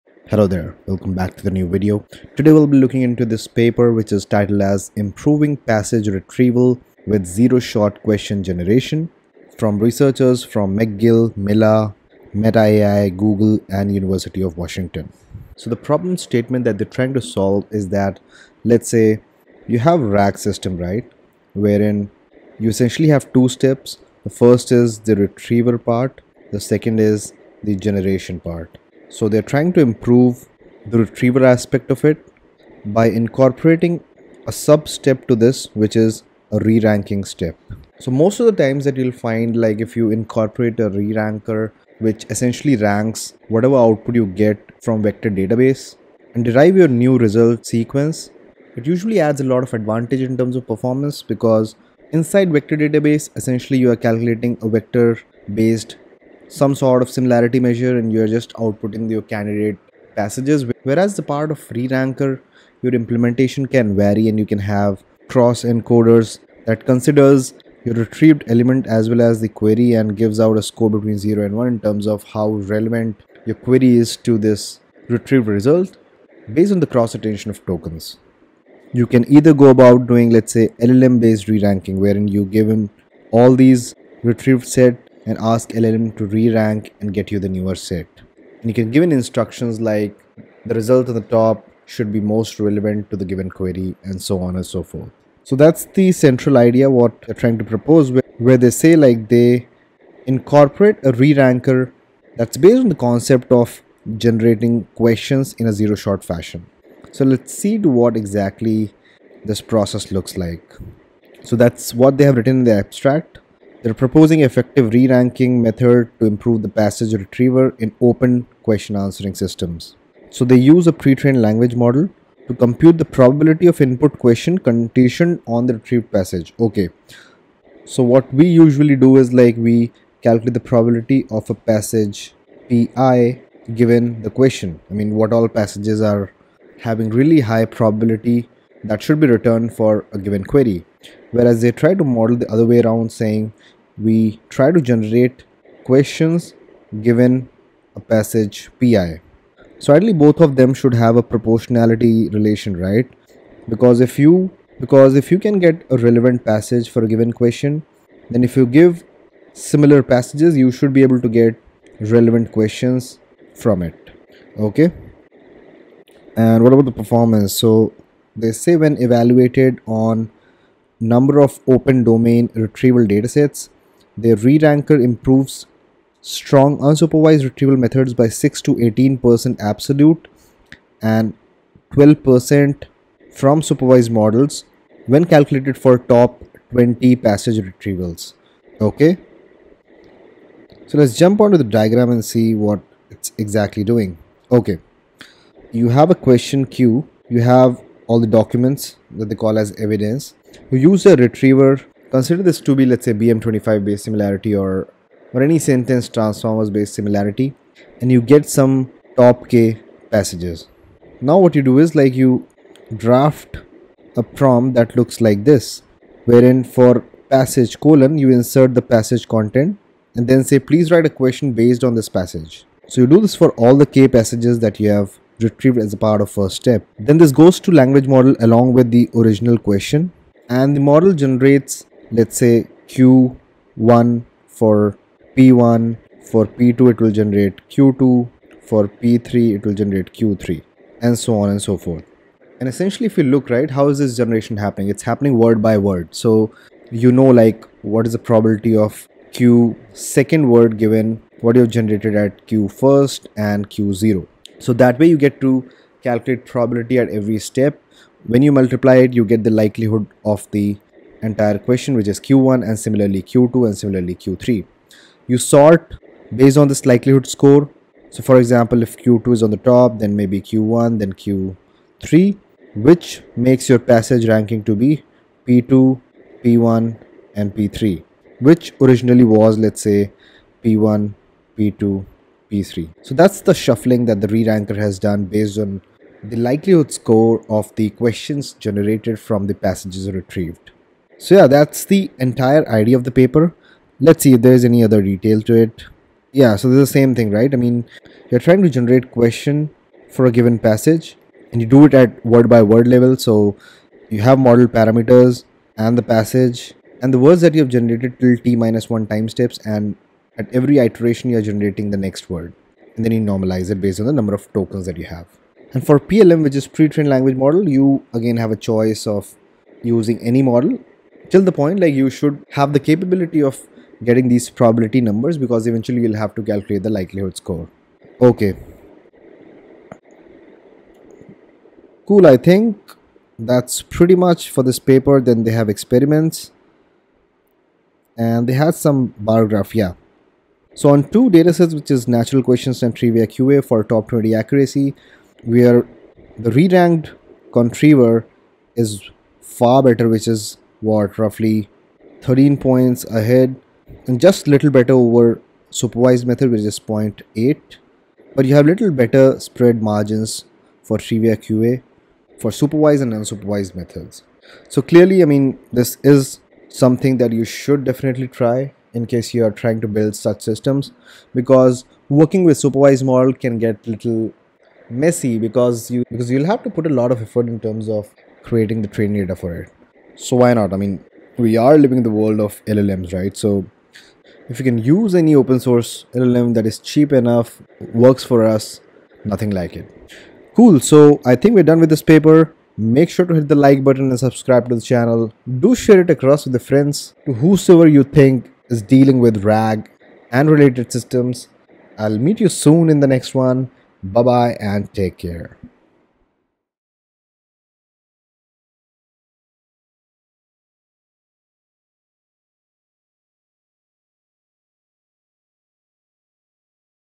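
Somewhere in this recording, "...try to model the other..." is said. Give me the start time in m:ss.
2:21.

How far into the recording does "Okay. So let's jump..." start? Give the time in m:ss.
3:08.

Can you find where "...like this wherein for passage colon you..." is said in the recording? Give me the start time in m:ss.
3:35.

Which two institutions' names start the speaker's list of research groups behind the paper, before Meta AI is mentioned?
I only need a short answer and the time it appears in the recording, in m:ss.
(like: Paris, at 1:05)
McGill, Mila, at 0:10.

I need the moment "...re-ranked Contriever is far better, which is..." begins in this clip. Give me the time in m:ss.
5:46.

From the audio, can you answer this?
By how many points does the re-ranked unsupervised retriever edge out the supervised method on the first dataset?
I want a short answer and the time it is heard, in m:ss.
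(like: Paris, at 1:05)
0.8, at 5:56.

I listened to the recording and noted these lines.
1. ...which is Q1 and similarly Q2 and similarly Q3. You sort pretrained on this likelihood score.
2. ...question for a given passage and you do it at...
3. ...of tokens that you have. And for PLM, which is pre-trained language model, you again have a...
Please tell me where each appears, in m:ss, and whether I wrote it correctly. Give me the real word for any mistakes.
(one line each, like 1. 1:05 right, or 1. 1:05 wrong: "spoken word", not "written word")
1. 4:21 wrong: "based", not "pretrained"
2. 4:59 right
3. 5:14 right.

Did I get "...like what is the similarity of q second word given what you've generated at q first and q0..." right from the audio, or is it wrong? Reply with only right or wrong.
wrong.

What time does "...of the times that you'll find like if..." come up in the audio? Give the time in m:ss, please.
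0:38.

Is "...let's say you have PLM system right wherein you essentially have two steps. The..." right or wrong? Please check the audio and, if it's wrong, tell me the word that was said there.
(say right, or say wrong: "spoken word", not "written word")
wrong: "RAG", not "PLM".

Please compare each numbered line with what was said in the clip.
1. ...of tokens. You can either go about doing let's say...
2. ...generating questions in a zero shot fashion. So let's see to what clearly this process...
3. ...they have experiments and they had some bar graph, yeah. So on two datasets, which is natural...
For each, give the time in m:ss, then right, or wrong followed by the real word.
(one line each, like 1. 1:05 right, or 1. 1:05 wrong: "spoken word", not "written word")
1. 1:17 right
2. 1:44 wrong: "exactly", not "clearly"
3. 5:35 right.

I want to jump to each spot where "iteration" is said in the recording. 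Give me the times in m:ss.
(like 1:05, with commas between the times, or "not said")
5:10.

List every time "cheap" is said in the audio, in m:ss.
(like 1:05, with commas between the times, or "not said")
6:26.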